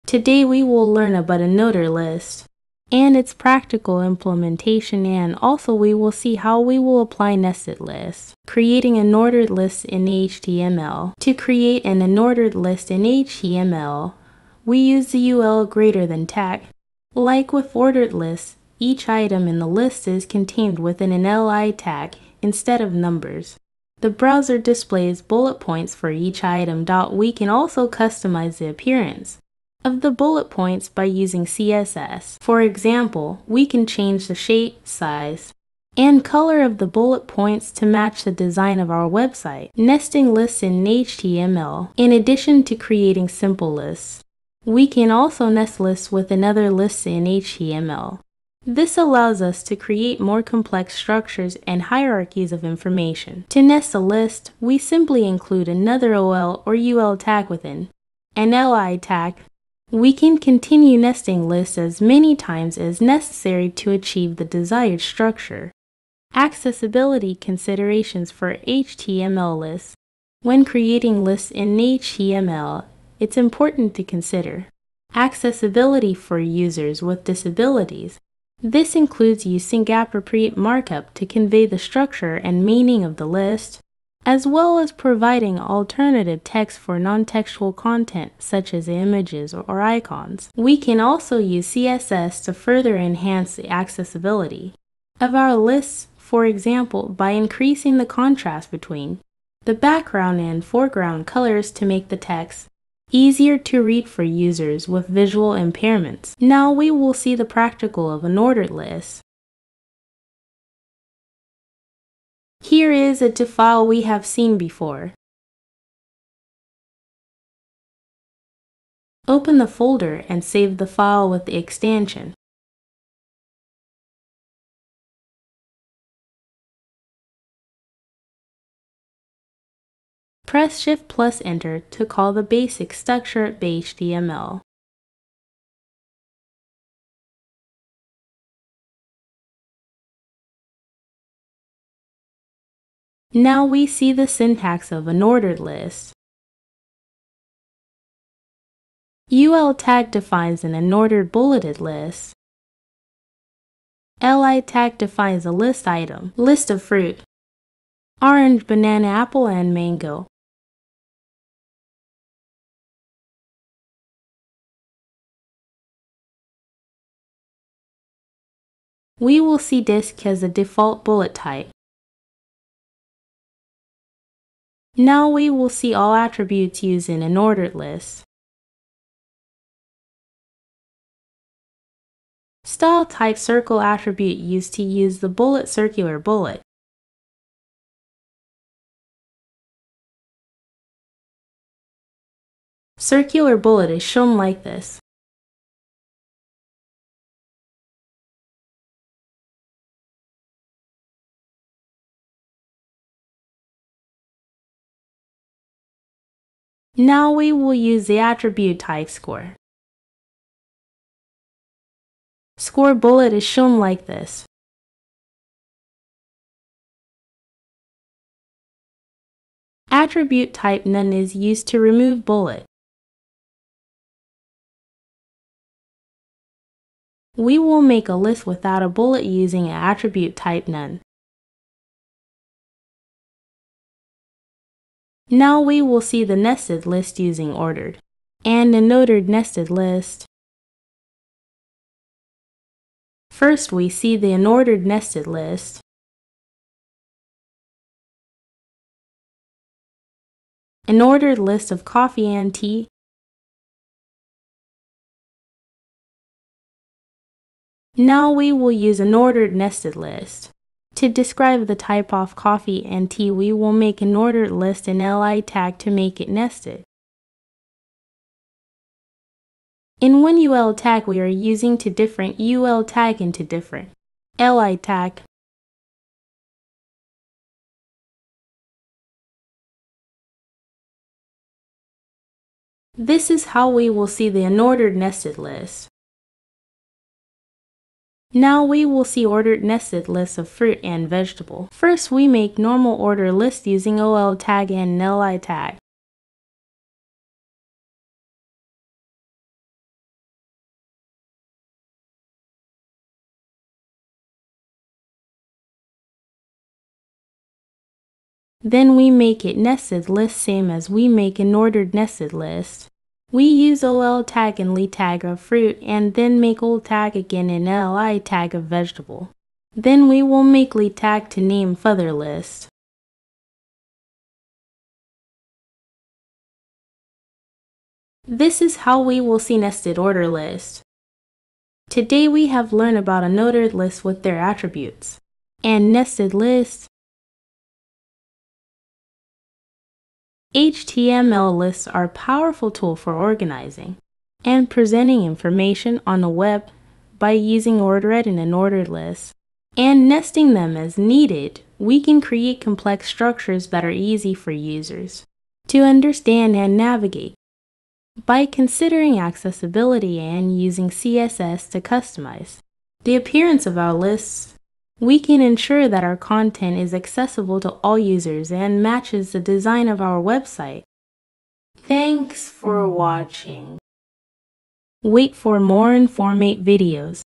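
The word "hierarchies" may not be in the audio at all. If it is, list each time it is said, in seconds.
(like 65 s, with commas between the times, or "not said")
51 s.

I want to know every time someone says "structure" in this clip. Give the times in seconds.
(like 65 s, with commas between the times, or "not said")
50 s, 65 s, 81 s, 132 s, 353 s.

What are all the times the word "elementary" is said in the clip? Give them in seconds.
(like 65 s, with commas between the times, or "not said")
not said.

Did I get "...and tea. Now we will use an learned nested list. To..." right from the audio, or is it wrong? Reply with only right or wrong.
wrong.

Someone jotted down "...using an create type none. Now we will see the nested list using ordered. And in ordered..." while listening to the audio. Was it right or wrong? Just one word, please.
wrong.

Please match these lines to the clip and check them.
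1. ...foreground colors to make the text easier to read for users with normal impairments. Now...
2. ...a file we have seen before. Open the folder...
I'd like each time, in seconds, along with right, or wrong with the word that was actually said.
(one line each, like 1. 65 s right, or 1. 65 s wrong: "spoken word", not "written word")
1. 100 s wrong: "visual", not "normal"
2. 113 s right.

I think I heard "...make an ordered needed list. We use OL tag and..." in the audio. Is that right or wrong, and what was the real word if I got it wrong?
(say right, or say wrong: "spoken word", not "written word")
wrong: "nested", not "needed".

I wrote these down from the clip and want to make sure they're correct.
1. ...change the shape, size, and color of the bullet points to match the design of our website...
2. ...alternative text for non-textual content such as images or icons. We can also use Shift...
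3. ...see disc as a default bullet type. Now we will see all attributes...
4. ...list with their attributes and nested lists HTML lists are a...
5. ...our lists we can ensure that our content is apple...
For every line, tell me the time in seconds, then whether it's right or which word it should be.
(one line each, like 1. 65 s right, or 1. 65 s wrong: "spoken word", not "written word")
1. 33 s right
2. 85 s wrong: "CSS", not "Shift"
3. 169 s right
4. 333 s right
5. 363 s wrong: "accessible", not "apple".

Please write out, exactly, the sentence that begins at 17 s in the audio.
Like with ordered lists, each item in the list is contained within an li tag instead of numbers.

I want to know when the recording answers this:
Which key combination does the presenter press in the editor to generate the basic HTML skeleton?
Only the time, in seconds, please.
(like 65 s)
130 s.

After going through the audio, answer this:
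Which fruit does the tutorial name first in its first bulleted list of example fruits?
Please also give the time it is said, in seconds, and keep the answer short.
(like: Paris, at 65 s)
Orange, at 158 s.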